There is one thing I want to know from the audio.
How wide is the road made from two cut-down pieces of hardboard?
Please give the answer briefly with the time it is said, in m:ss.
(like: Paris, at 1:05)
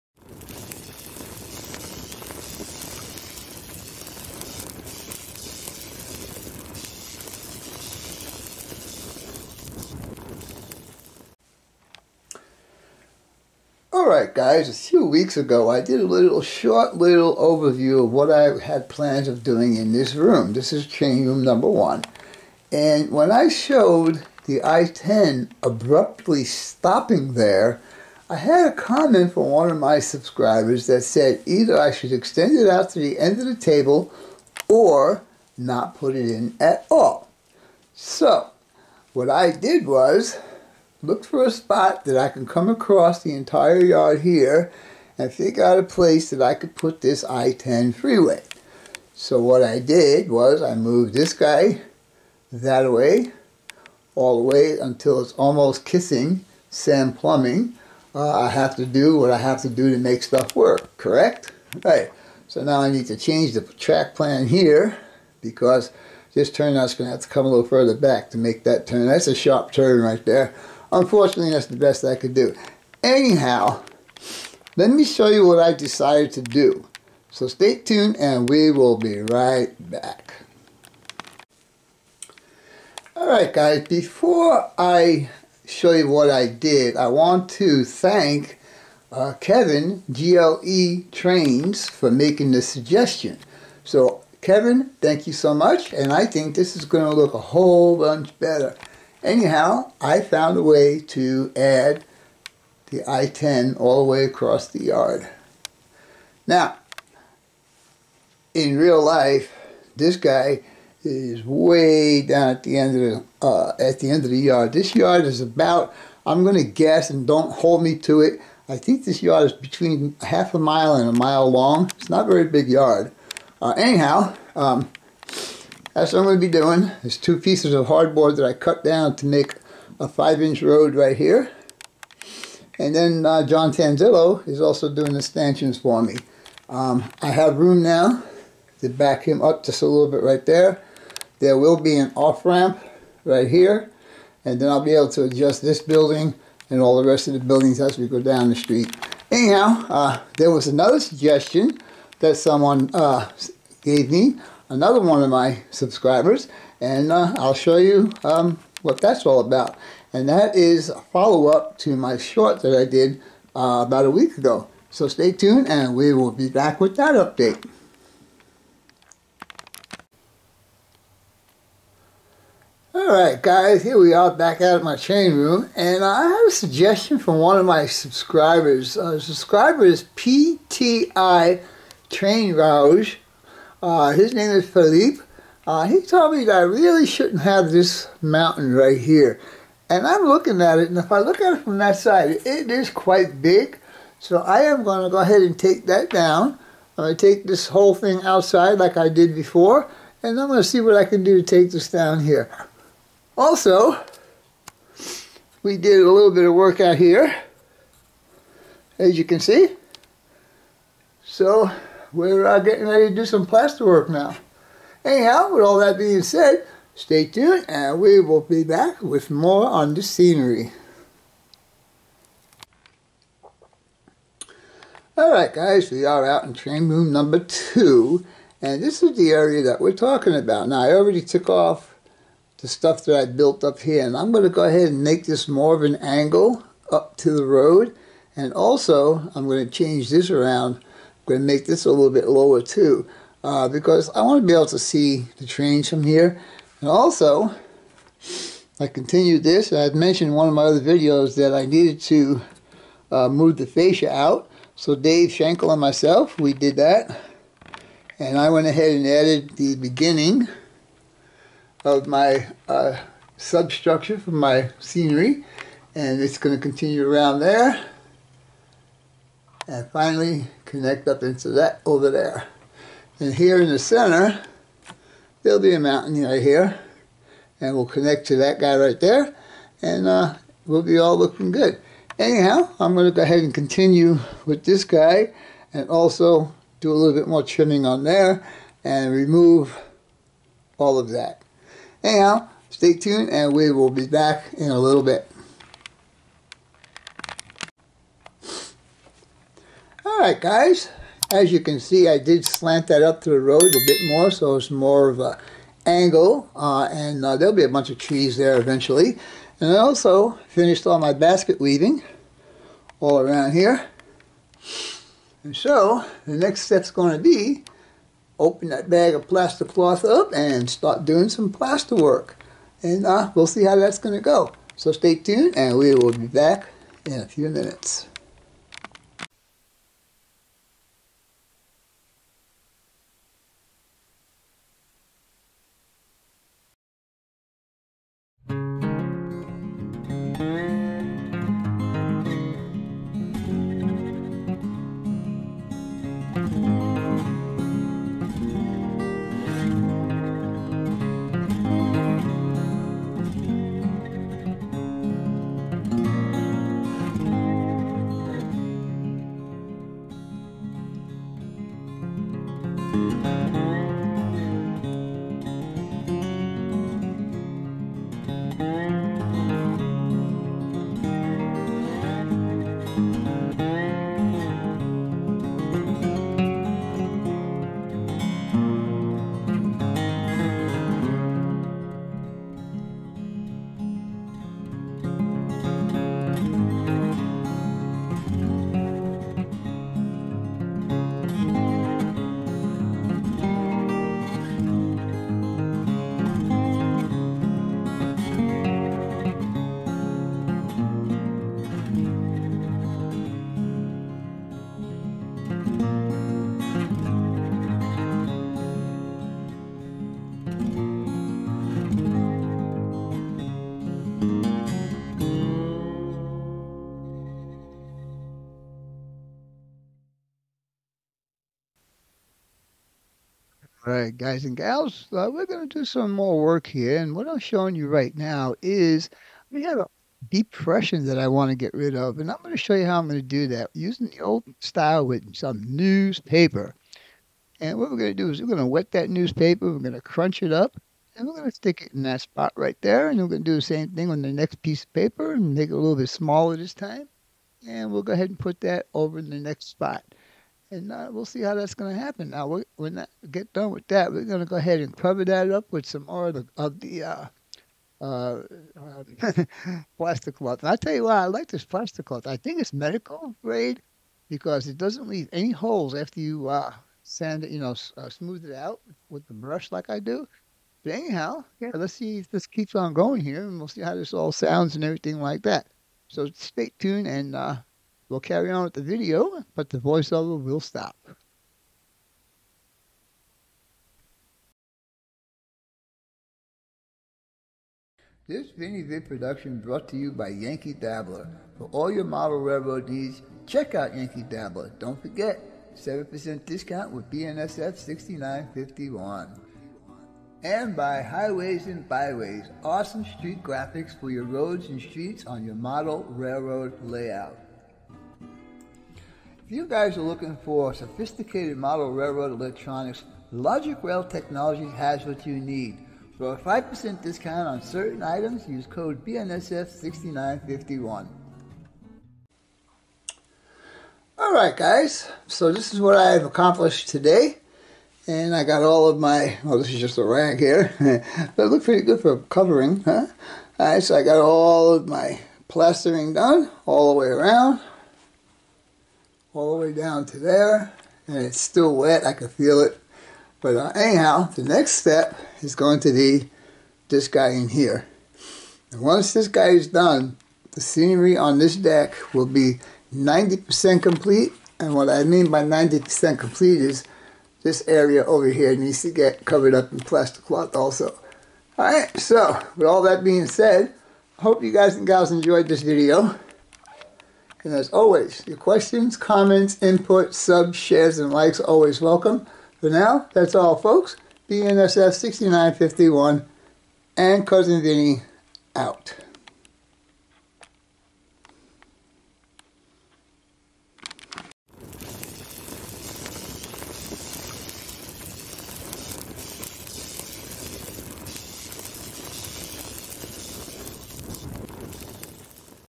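5 inches, at 2:10.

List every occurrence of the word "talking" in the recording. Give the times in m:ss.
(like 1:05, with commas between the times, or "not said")
3:49.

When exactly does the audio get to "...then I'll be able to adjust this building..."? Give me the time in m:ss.
2:24.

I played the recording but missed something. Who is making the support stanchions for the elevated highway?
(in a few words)
John Tanzillo.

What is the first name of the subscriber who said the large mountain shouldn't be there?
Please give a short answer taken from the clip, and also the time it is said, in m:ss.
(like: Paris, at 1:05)
Philippe, at 3:04.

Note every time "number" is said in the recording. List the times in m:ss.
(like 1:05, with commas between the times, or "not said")
0:21, 3:47.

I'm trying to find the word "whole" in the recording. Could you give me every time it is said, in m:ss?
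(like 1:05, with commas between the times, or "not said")
1:37, 3:17.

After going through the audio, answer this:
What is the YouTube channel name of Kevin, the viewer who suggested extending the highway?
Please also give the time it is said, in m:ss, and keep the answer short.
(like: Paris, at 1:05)
GLE Trains, at 1:30.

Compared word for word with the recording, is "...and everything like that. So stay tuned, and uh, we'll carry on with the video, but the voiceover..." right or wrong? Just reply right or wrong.
right.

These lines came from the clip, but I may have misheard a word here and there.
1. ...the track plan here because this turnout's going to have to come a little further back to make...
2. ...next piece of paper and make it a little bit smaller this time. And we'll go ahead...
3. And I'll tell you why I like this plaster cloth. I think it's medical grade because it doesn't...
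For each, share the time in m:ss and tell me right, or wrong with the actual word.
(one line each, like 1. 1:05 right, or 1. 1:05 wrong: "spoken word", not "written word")
1. 1:03 right
2. 7:24 right
3. 7:40 right.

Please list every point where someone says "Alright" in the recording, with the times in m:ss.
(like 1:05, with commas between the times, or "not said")
0:14, 1:23, 2:52, 3:45, 5:00, 8:44, 8:53, 9:21.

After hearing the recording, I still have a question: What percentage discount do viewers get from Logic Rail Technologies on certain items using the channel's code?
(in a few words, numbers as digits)
5%.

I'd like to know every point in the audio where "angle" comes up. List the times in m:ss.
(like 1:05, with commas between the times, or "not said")
3:55, 5:05.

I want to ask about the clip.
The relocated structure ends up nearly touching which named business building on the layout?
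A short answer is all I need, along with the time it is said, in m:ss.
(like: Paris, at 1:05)
Sam Plumbing, at 0:56.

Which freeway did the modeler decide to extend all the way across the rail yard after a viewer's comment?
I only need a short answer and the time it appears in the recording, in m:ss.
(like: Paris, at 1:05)
I-10, at 0:47.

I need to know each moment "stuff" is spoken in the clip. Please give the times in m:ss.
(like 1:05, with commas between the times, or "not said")
1:00, 3:52.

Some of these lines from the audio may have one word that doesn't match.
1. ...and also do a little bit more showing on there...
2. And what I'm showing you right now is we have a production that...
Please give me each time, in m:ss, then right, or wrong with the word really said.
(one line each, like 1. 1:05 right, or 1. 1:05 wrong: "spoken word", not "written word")
1. 4:45 wrong: "trimming", not "showing"
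2. 7:06 wrong: "depression", not "production".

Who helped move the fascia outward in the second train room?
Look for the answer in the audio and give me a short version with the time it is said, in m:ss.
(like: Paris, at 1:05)
Dave Schenkel, at 4:14.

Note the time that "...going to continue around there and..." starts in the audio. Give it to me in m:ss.
4:26.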